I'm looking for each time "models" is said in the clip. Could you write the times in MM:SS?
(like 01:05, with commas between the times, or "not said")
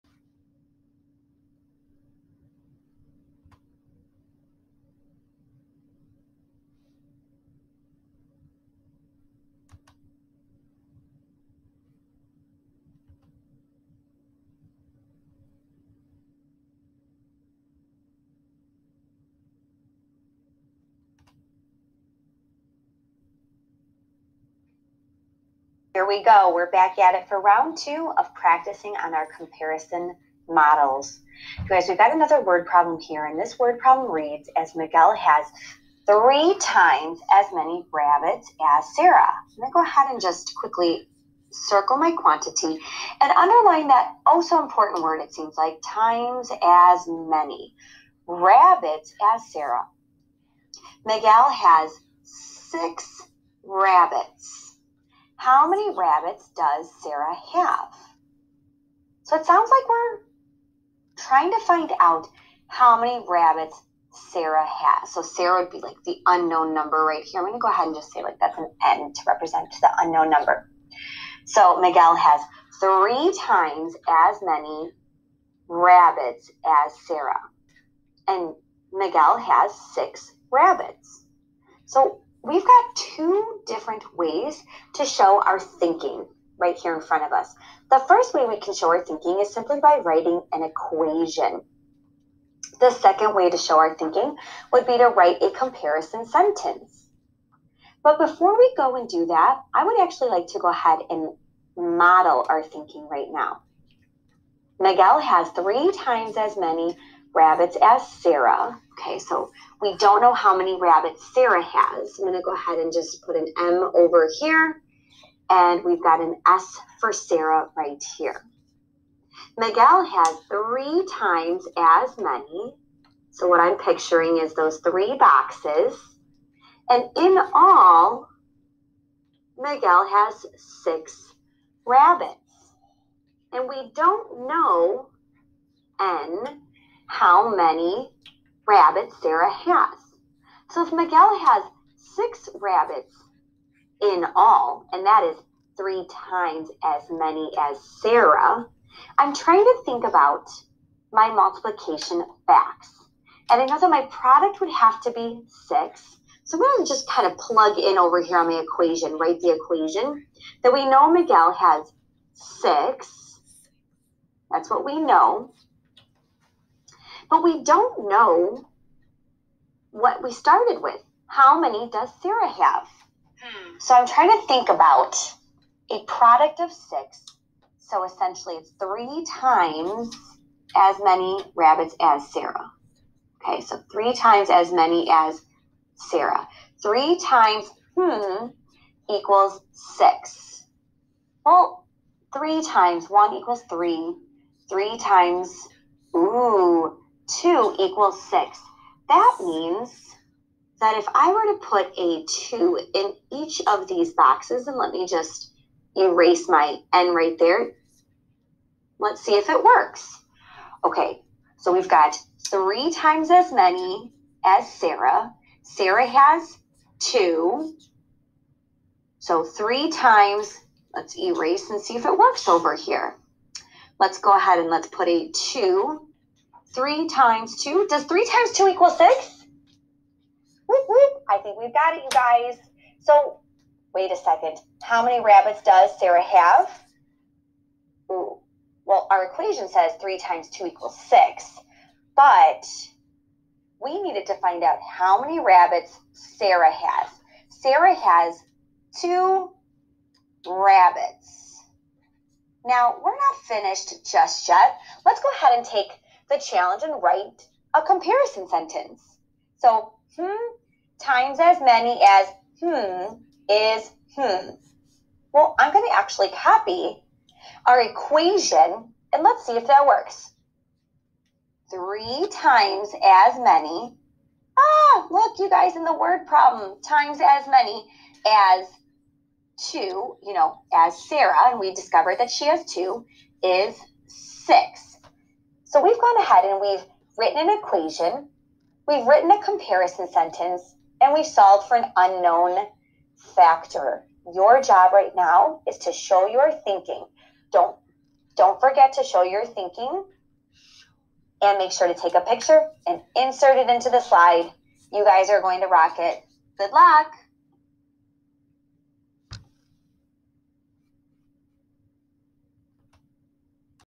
00:30, 01:41.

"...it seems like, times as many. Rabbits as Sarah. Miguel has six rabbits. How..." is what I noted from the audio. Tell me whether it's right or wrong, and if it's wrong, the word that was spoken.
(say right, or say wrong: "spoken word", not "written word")
right.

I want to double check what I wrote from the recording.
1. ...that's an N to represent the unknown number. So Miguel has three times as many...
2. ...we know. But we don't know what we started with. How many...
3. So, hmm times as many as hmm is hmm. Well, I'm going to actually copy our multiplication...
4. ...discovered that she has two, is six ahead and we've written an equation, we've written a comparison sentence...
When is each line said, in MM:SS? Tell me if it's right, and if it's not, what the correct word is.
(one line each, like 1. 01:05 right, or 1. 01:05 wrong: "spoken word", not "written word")
1. 01:08 right
2. 02:44 right
3. 04:19 wrong: "equation", not "multiplication"
4. 04:41 right.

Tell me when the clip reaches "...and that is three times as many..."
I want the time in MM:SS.
02:24.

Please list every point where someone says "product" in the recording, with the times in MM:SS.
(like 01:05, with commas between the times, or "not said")
02:34, 02:56.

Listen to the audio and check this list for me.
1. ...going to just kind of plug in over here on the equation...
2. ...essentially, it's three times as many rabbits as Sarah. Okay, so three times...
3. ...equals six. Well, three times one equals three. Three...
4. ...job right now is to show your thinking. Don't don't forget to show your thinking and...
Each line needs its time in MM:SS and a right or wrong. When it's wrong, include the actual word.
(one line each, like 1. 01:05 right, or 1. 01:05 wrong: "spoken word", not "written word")
1. 02:36 right
2. 02:58 right
3. 03:09 right
4. 04:54 right.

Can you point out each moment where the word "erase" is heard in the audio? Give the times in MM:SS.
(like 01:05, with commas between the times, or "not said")
03:25, 03:41.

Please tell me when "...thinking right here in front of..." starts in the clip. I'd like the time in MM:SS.
01:25.